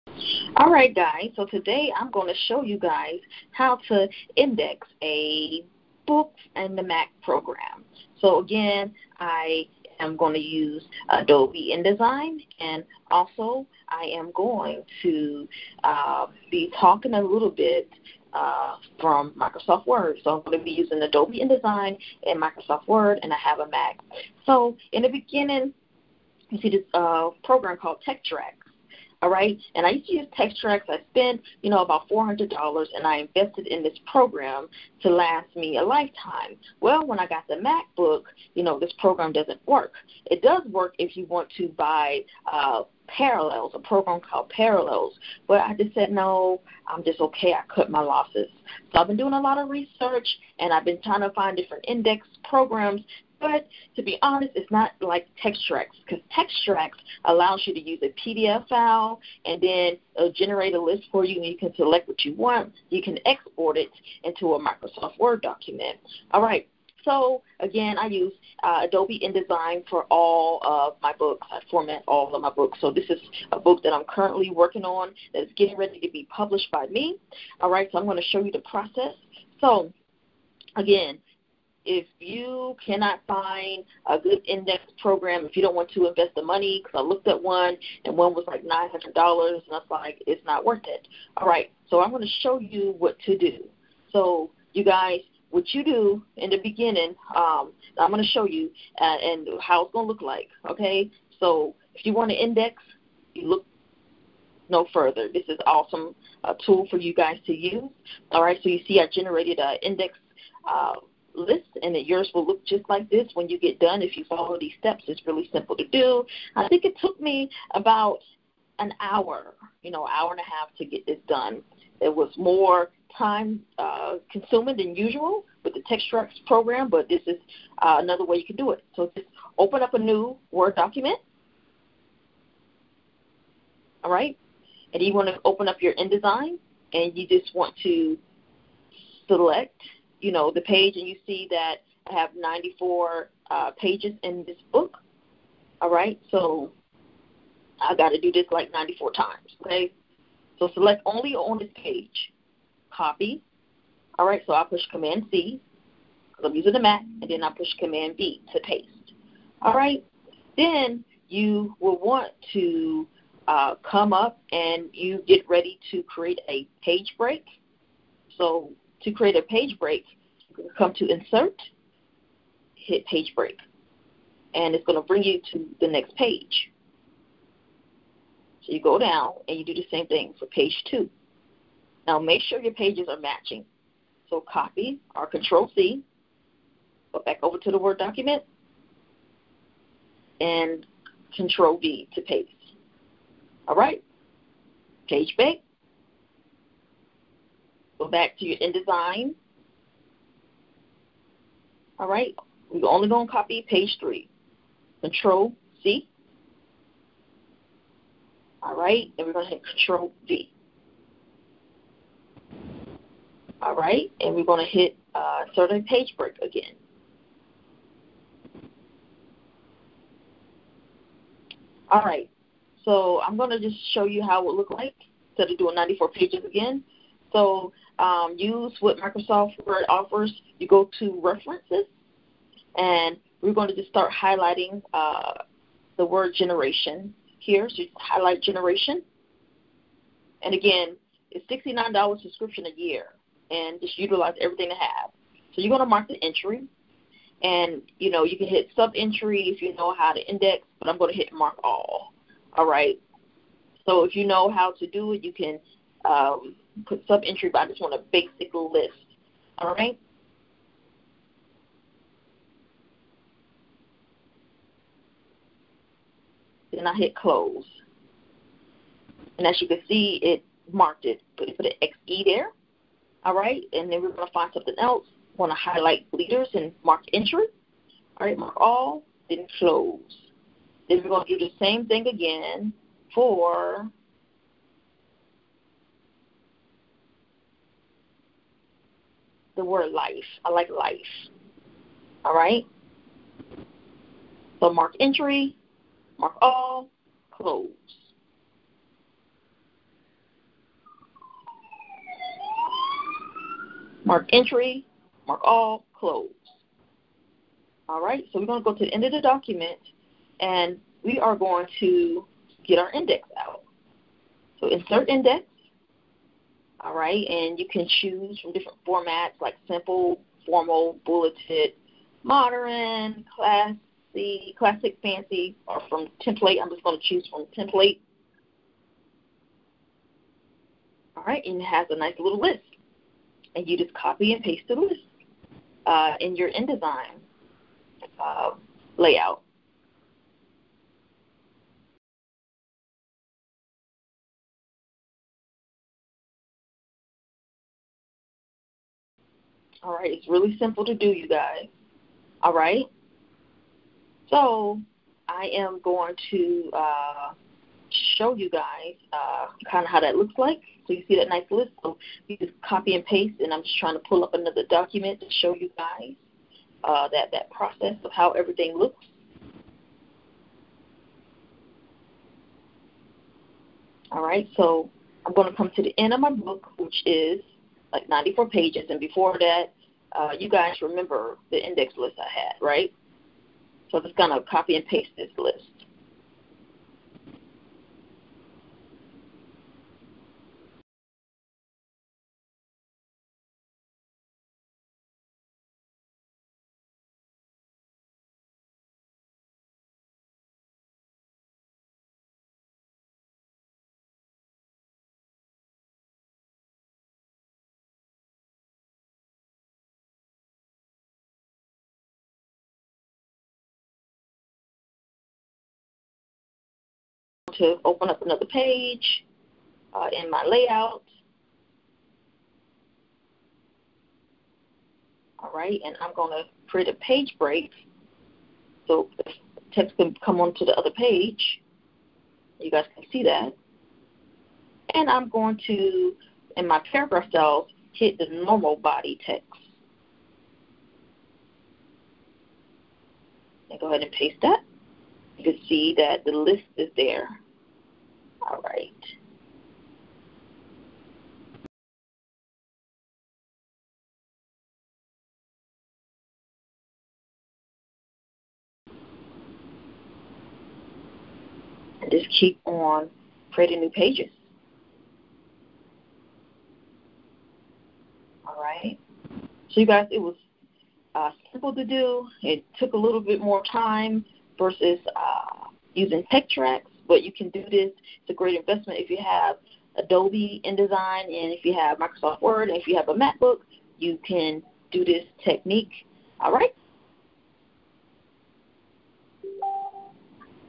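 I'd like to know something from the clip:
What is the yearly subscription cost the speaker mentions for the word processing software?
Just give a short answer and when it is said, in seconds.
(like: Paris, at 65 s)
$69, at 241 s.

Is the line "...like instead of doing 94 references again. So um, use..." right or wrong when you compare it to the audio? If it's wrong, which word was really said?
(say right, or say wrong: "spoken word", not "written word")
wrong: "pages", not "references".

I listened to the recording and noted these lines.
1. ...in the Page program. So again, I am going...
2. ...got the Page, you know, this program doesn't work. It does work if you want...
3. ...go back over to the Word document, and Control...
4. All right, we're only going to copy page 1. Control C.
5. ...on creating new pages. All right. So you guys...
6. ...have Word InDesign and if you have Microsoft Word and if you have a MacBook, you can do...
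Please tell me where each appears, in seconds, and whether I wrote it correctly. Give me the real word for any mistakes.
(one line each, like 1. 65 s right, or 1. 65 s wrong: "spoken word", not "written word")
1. 6 s wrong: "Mac", not "Page"
2. 37 s wrong: "MacBook", not "Page"
3. 187 s right
4. 201 s wrong: "3", not "1"
5. 462 s right
6. 479 s wrong: "Adobe", not "Word".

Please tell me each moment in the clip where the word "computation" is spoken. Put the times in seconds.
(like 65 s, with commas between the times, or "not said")
not said.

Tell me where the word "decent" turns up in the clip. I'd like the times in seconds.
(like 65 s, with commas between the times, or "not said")
not said.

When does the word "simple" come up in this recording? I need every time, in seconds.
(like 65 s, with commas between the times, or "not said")
115 s, 319 s, 350 s, 471 s.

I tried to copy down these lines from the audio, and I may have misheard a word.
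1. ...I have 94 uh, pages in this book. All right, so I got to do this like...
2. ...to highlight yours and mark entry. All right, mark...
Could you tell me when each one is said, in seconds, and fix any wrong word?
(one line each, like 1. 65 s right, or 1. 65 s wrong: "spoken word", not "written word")
1. 142 s right
2. 275 s wrong: "leaders", not "yours".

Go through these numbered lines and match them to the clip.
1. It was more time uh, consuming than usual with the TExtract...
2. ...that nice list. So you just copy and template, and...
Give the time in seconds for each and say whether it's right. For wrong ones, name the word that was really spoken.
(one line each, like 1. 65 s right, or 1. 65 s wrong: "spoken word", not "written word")
1. 121 s right
2. 361 s wrong: "paste", not "template".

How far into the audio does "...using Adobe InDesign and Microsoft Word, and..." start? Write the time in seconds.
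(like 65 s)
20 s.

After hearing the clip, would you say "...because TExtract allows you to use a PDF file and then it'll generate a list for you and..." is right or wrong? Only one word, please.
right.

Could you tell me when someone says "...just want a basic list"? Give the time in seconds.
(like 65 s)
257 s.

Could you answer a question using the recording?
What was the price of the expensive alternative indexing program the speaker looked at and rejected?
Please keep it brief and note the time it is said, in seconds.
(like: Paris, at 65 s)
$900, at 88 s.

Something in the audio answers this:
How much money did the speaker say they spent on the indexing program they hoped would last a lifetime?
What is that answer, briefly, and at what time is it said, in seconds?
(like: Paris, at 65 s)
$400, at 32 s.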